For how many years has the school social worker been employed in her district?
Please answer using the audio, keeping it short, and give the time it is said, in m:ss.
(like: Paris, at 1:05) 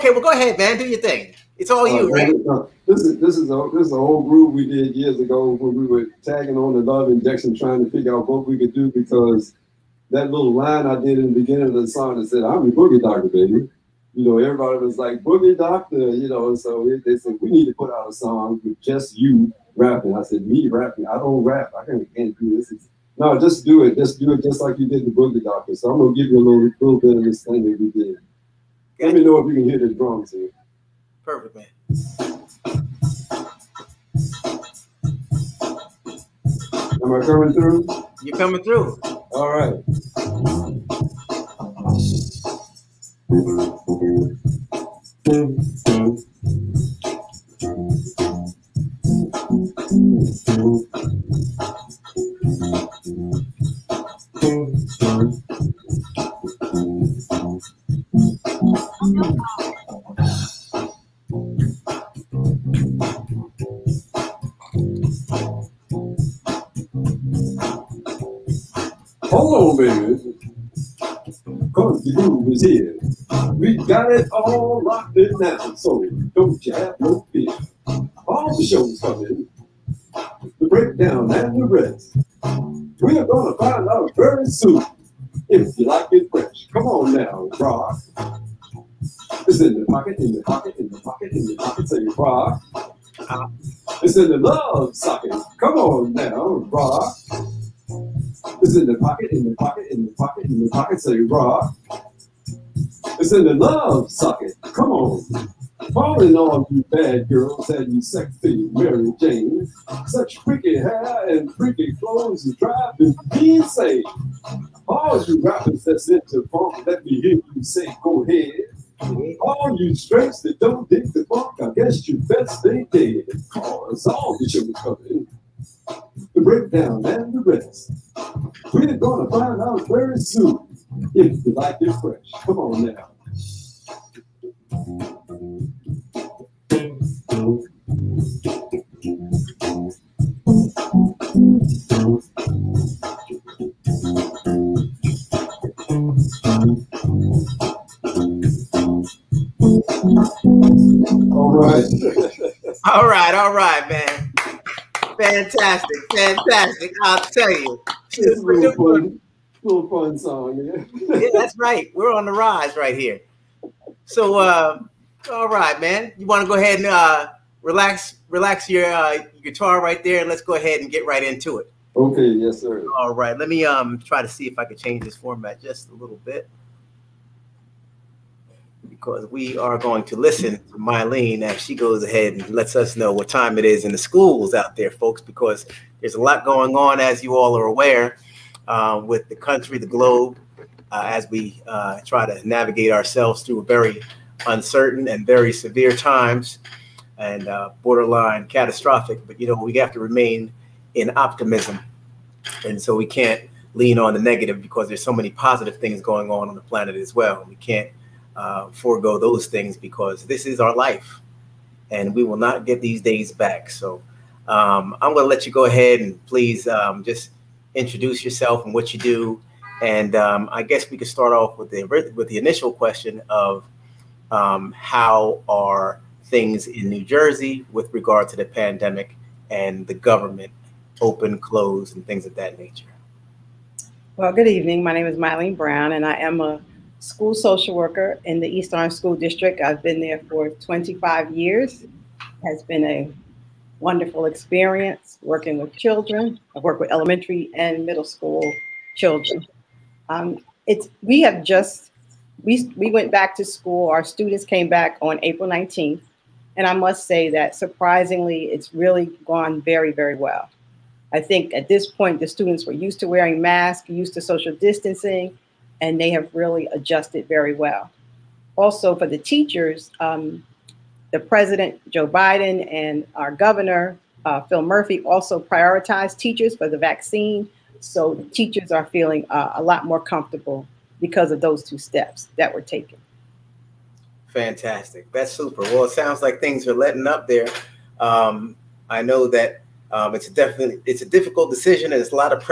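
25 years, at 4:00.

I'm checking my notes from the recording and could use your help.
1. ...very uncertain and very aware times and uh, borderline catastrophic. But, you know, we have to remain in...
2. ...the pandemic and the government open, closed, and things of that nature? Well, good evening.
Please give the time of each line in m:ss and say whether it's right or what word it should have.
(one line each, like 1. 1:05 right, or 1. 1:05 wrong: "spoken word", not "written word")
1. 3:13 wrong: "severe", not "aware"
2. 3:48 right.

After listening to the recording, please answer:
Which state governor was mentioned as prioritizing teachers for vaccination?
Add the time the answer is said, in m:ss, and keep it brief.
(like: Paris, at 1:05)
Phil Murphy, at 4:34.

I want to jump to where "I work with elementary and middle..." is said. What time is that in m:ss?
4:06.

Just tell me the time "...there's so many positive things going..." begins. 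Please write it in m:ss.
3:24.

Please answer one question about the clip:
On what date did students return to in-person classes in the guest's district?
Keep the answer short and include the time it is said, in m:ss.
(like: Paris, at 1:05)
April 19th, at 4:15.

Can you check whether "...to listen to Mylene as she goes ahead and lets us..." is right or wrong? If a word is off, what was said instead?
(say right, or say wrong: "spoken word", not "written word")
right.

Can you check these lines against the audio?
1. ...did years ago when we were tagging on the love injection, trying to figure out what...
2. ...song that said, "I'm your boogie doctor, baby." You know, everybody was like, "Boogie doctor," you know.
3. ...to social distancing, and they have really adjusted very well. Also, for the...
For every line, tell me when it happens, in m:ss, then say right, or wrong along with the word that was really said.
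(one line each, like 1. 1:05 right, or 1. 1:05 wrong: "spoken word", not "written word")
1. 0:04 right
2. 0:11 right
3. 4:24 right.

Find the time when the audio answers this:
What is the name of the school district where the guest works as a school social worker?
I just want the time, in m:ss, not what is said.
3:58.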